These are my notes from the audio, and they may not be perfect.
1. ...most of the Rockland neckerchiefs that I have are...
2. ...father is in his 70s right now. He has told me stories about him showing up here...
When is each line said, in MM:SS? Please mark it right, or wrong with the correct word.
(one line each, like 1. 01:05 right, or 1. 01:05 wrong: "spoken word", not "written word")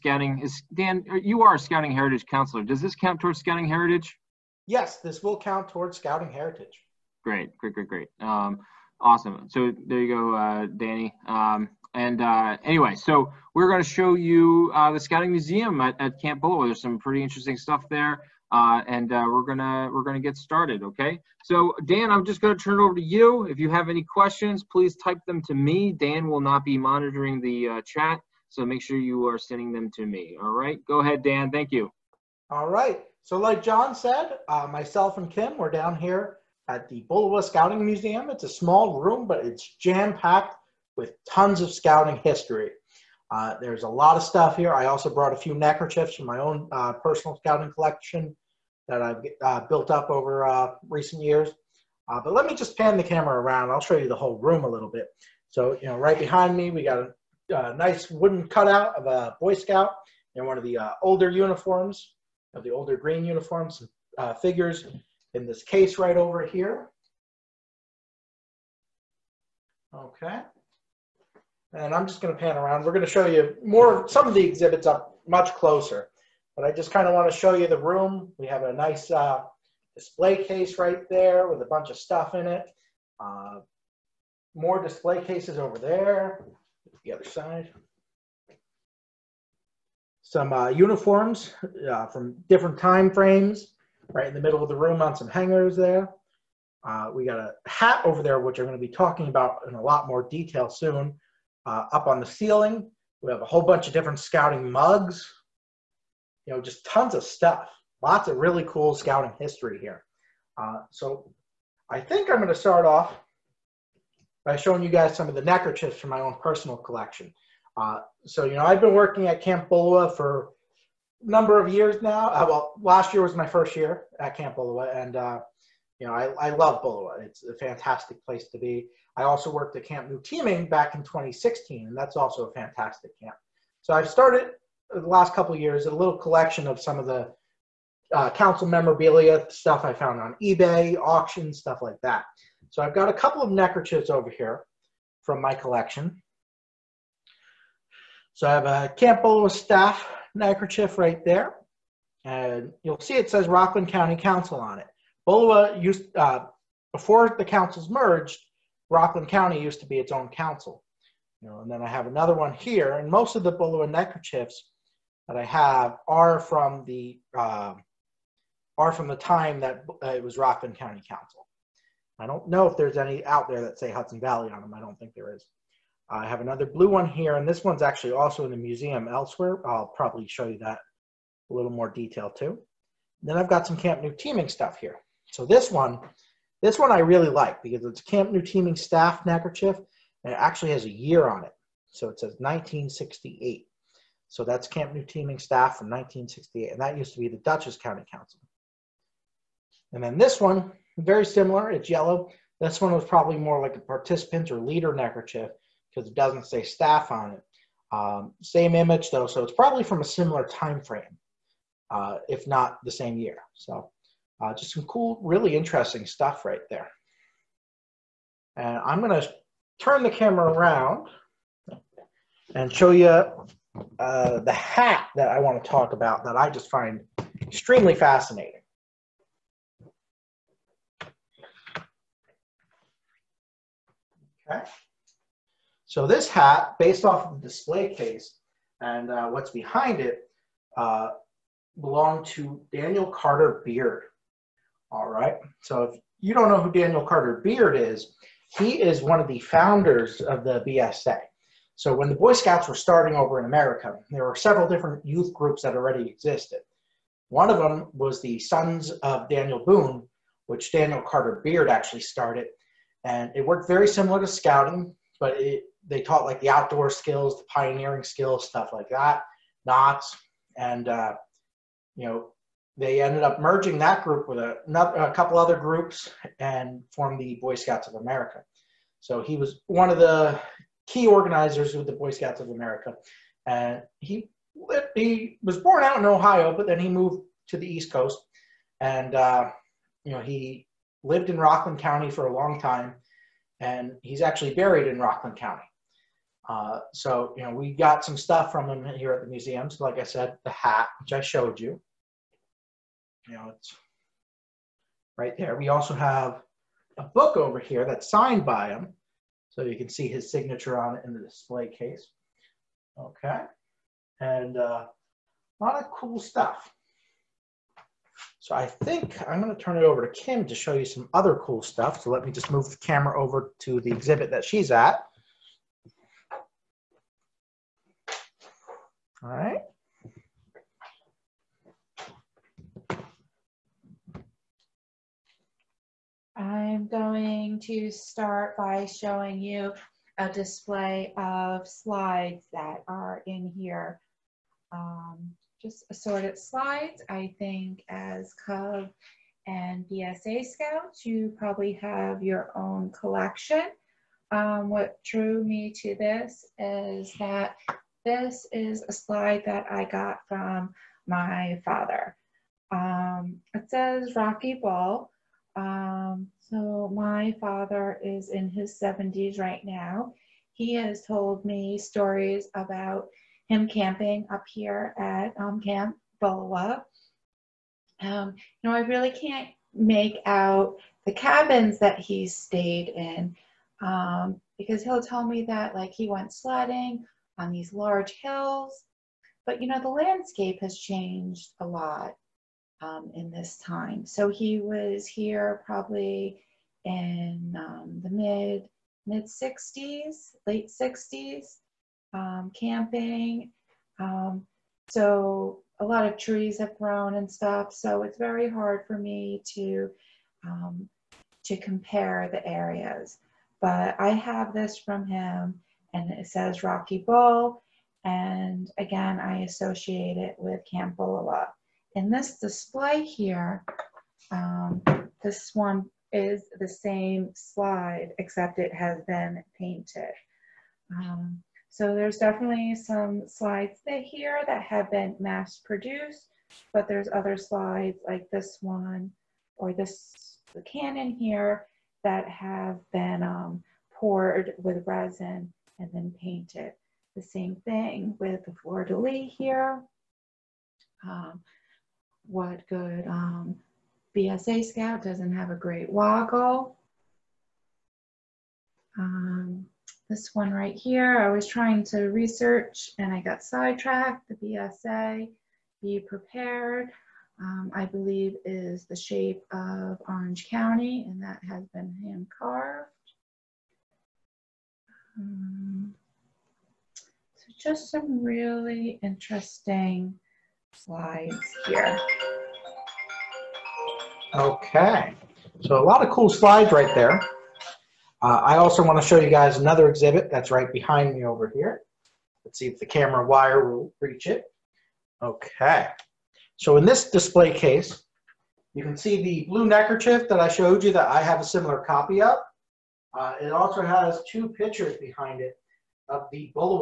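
1. 02:43 wrong: "Bullowa", not "Rockland"
2. 06:07 wrong: "camping", not "showing".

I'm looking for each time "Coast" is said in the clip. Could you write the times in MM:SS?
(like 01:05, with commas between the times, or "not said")
04:47.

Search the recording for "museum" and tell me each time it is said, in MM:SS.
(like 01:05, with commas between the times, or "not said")
00:15, 00:37, 02:58, 04:59.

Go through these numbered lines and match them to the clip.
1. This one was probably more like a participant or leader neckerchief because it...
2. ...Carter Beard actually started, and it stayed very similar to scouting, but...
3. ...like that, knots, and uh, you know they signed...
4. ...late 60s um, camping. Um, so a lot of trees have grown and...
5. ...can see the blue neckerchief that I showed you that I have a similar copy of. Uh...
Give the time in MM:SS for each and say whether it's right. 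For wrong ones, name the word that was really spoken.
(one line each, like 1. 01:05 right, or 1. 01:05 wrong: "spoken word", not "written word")
1. 03:22 right
2. 04:21 wrong: "worked", not "stayed"
3. 04:28 wrong: "ended", not "signed"
4. 06:40 right
5. 08:18 right.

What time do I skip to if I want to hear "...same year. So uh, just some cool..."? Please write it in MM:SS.
03:32.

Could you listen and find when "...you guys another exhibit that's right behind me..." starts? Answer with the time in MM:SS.
08:09.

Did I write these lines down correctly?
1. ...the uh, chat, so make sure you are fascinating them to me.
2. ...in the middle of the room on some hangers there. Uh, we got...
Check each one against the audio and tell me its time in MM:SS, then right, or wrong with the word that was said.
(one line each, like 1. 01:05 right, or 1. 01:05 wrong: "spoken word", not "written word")
1. 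00:27 wrong: "sending", not "fascinating"
2. 01:34 right.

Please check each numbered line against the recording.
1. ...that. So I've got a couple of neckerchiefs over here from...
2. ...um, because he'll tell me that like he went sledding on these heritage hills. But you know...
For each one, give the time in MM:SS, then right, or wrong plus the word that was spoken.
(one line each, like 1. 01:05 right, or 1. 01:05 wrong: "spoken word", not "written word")
1. 02:22 right
2. 06:23 wrong: "large", not "heritage".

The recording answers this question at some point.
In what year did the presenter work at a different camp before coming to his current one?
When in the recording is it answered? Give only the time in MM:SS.
02:11.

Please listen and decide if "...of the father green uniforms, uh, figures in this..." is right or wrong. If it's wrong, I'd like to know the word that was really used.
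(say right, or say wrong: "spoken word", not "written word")
wrong: "older", not "father".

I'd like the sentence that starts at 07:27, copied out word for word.
The same thing with the fleur-de-lis here.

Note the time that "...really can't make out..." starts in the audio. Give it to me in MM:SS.
06:18.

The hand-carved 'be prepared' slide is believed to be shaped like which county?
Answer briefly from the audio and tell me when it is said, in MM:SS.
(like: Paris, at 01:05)
Orange County, at 07:50.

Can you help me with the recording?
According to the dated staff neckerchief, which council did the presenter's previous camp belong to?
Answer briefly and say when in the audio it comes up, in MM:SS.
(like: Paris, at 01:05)
Dutchess County Council, at 03:17.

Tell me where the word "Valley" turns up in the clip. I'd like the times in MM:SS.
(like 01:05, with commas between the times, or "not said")
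02:54.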